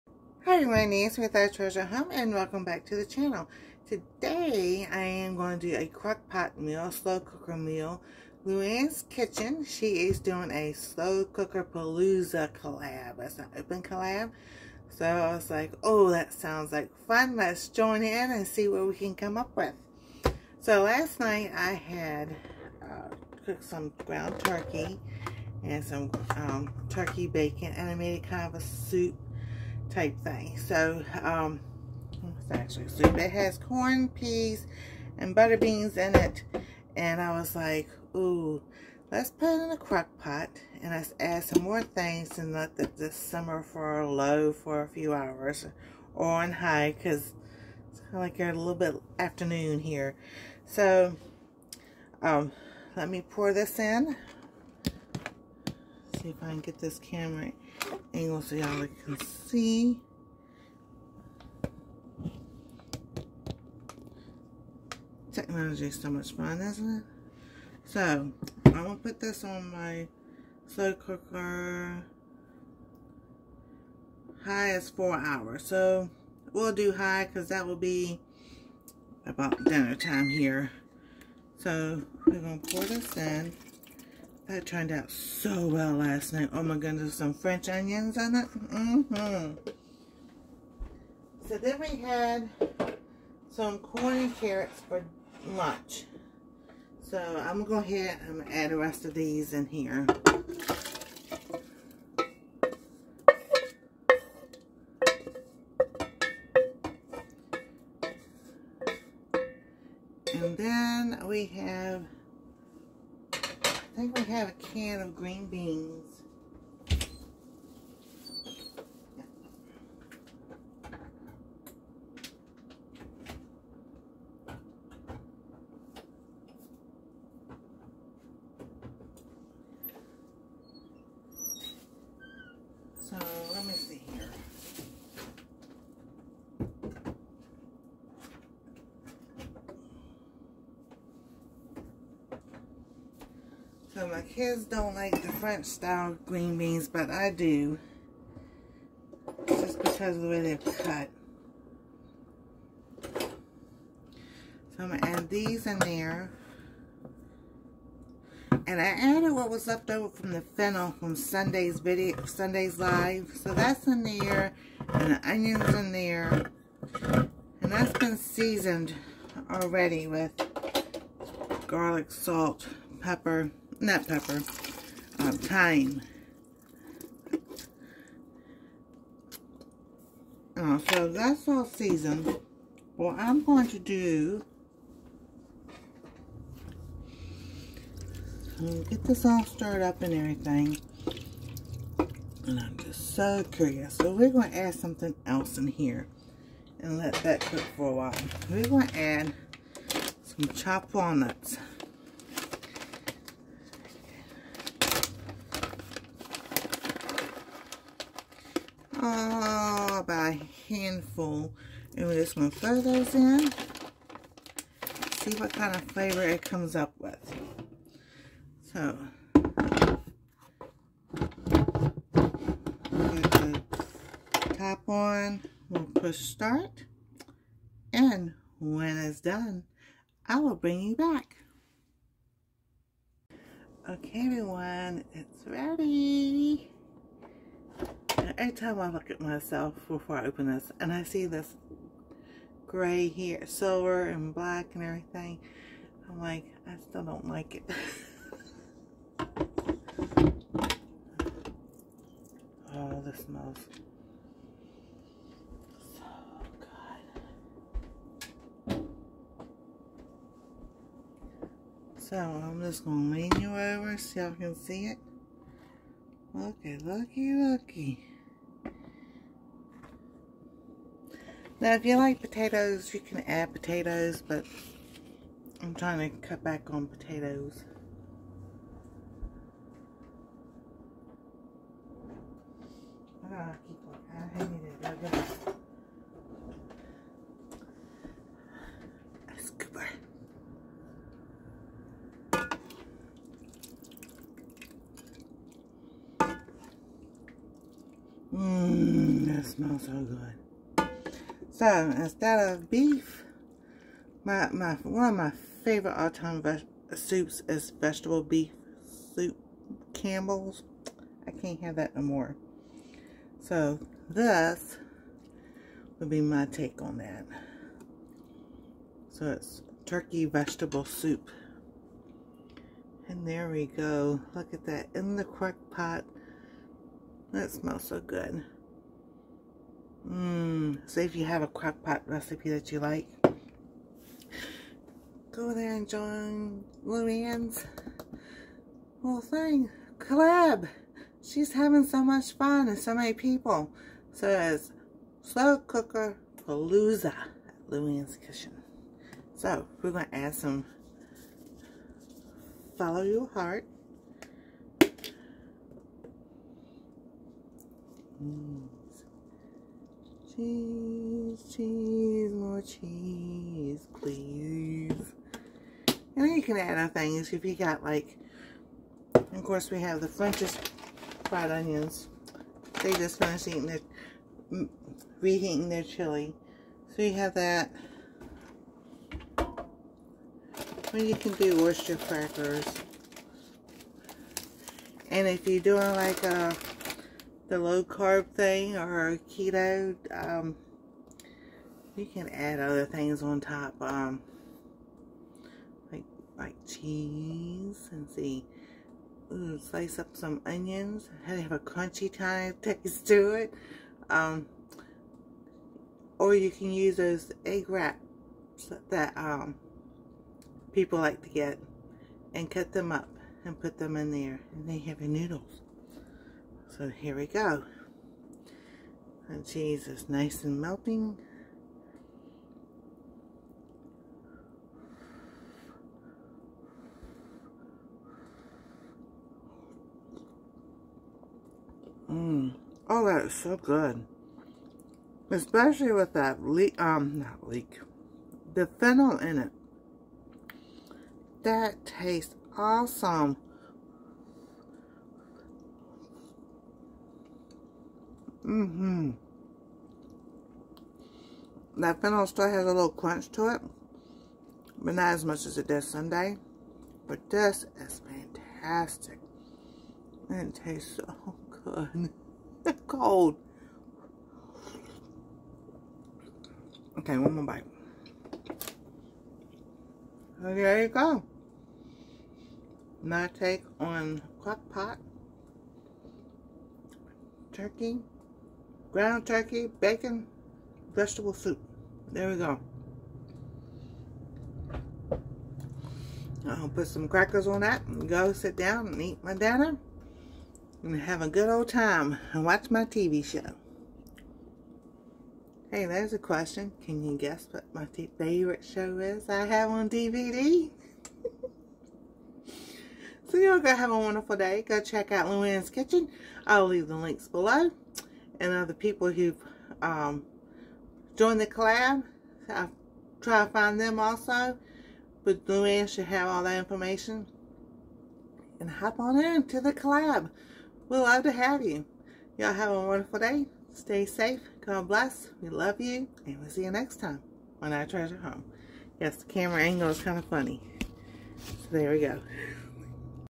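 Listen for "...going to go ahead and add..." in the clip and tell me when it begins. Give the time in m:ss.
1:37.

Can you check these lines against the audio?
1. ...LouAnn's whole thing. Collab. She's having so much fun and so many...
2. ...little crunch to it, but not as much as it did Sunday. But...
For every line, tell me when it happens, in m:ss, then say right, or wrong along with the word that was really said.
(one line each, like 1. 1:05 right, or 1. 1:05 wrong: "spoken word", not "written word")
1. 5:36 right
2. 7:32 right.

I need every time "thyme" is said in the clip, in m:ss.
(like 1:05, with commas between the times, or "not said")
2:55.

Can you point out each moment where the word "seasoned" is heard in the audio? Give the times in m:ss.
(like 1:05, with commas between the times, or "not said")
2:48, 3:01.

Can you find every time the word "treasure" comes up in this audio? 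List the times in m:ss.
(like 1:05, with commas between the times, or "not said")
0:01, 8:47.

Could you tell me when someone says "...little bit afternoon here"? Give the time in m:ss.
0:48.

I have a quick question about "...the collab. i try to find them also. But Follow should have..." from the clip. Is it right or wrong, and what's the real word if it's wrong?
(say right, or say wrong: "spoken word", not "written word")
wrong: "LouAnn", not "Follow".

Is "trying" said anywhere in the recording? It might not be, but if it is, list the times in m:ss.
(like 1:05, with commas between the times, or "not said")
4:35.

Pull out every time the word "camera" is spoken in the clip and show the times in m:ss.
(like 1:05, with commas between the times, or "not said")
0:56, 8:49.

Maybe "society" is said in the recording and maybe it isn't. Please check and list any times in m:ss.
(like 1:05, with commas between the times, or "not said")
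not said.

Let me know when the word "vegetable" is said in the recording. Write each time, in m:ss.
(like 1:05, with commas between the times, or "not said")
5:07, 5:20, 8:00.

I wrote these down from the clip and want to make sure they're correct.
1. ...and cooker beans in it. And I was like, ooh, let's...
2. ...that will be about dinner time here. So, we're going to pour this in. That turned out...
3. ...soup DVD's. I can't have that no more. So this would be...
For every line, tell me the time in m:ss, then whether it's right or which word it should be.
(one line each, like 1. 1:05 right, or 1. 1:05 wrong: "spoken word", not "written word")
1. 0:35 wrong: "butter", not "cooker"
2. 1:17 right
3. 5:09 wrong: "Campbell", not "DVD".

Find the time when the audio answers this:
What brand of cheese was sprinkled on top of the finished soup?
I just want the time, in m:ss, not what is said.
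5:52.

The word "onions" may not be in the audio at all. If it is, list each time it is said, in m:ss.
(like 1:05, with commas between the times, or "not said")
1:27, 2:45, 6:11, 6:40.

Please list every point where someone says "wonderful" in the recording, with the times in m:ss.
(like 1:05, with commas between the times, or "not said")
8:23, 8:42.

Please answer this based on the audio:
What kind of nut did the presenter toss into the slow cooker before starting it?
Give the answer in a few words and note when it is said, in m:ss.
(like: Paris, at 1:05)
Walnuts, at 3:20.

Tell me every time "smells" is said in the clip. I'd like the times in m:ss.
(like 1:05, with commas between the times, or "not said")
4:13, 4:59, 5:27.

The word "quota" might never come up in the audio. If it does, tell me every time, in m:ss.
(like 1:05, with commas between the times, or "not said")
not said.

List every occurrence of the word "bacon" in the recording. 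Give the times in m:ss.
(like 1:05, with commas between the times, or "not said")
0:27, 7:59.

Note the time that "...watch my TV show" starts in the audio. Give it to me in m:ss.
8:12.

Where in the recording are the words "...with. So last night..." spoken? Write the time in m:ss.
0:19.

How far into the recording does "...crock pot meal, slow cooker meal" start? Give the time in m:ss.
0:05.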